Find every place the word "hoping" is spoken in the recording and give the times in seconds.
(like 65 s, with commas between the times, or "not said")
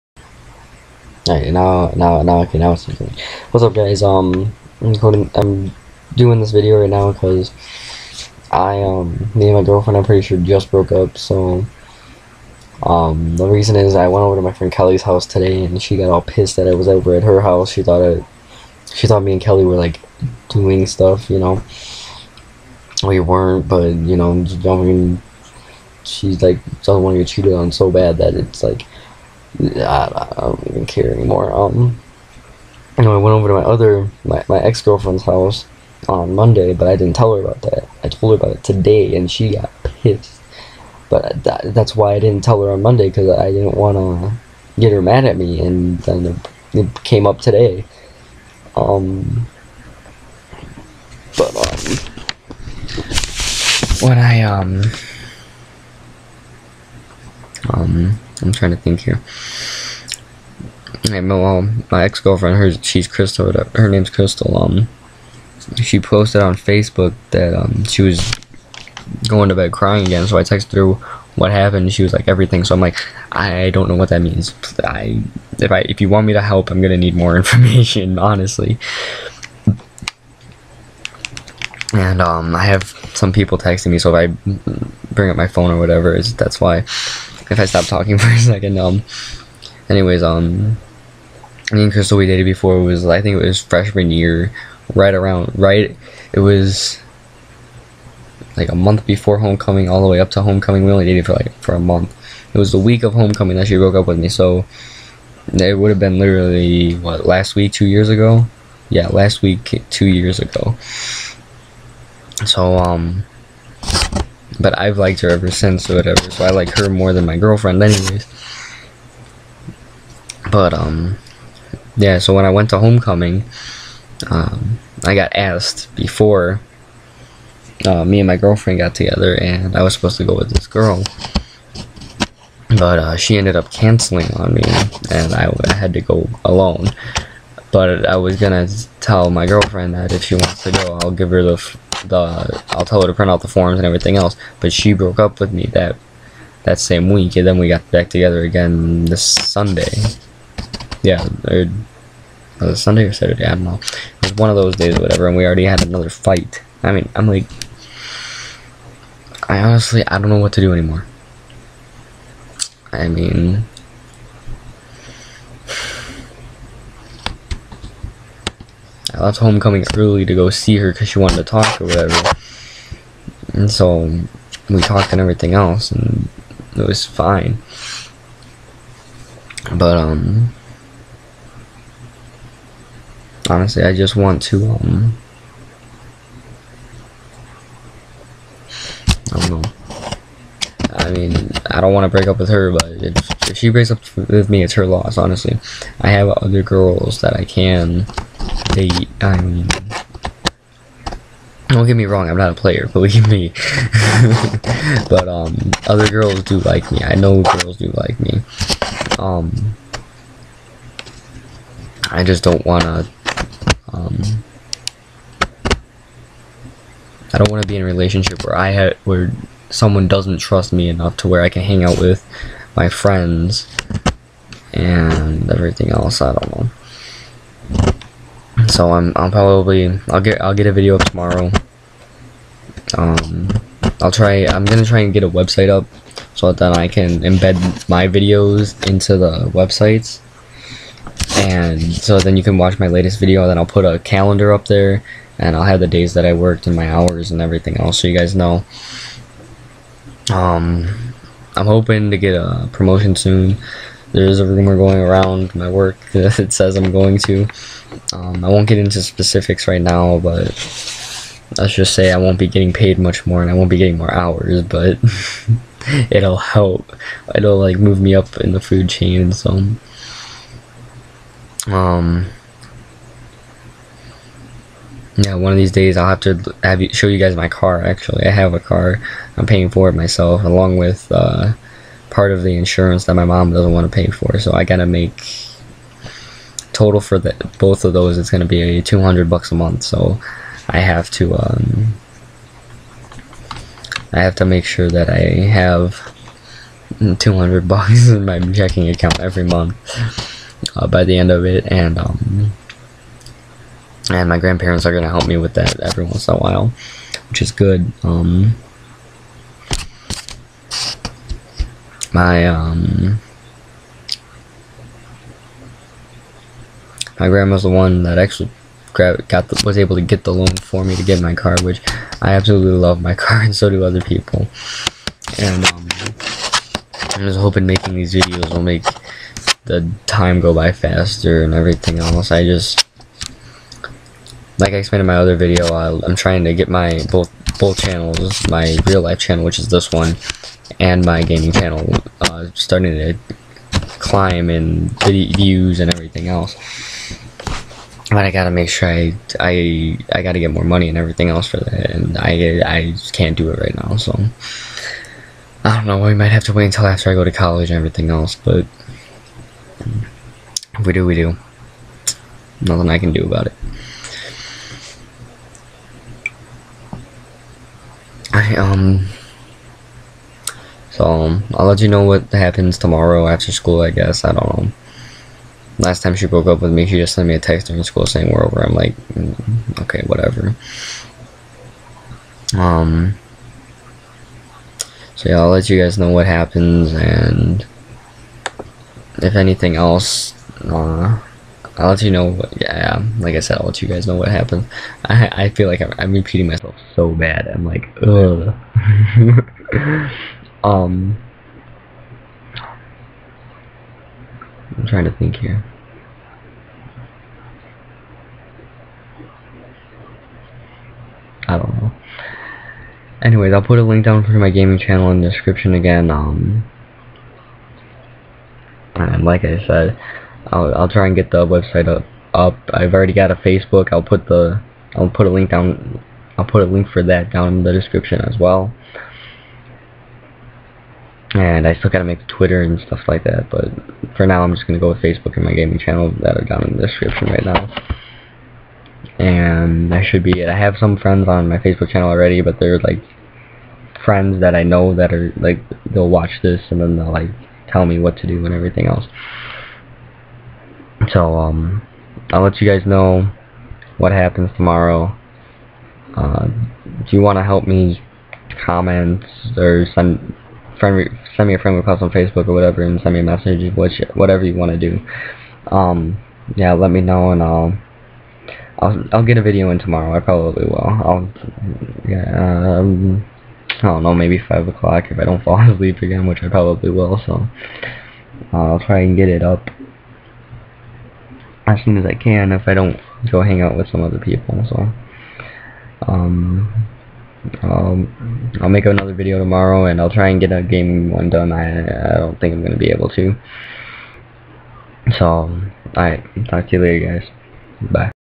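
251 s, 327 s.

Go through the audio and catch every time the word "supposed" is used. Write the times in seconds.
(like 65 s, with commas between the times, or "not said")
129 s.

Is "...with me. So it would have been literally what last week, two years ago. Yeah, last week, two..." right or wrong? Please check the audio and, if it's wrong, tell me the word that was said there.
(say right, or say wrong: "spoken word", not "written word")
right.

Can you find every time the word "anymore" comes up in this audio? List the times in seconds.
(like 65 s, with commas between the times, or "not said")
31 s, 160 s.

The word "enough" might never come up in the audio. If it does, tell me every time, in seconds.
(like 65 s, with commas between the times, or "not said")
220 s.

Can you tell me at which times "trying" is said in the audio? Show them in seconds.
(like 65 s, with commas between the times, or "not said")
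58 s, 336 s, 404 s.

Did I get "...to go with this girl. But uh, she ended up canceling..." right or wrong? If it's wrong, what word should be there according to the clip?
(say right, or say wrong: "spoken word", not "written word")
right.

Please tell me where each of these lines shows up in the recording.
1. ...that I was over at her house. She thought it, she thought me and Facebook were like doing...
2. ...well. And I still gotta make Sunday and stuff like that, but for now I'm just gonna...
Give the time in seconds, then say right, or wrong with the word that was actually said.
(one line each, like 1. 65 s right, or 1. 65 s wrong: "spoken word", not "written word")
1. 16 s wrong: "Kelly", not "Facebook"
2. 428 s wrong: "Twitter", not "Sunday".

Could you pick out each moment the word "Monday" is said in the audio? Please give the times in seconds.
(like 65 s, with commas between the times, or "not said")
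36 s, 42 s.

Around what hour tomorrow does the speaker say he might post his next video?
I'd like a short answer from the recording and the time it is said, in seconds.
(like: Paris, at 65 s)
5 o'clock, at 474 s.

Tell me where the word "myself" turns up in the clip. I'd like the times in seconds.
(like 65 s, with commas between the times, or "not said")
279 s, 396 s.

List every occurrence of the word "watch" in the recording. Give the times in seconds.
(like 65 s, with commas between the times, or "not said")
242 s, 446 s.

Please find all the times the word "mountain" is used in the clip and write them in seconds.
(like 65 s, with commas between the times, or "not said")
not said.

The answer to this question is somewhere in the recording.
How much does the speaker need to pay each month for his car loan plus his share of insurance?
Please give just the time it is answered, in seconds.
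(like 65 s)
288 s.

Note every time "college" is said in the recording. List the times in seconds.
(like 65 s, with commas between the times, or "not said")
357 s.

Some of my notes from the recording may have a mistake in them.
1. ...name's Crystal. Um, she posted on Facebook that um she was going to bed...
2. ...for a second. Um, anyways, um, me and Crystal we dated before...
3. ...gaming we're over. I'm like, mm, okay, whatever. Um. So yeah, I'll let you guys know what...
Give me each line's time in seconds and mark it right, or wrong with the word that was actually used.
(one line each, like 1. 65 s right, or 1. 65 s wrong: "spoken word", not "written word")
1. 63 s right
2. 88 s right
3. 378 s wrong: "saying", not "gaming".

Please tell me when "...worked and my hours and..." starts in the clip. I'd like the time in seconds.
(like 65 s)
246 s.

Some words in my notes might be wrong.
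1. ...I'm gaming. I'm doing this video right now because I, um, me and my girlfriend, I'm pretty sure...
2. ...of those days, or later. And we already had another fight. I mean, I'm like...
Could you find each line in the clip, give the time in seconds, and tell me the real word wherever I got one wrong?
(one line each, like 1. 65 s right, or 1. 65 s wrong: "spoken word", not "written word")
1. 4 s wrong: "recording", not "gaming"
2. 154 s wrong: "whatever", not "later".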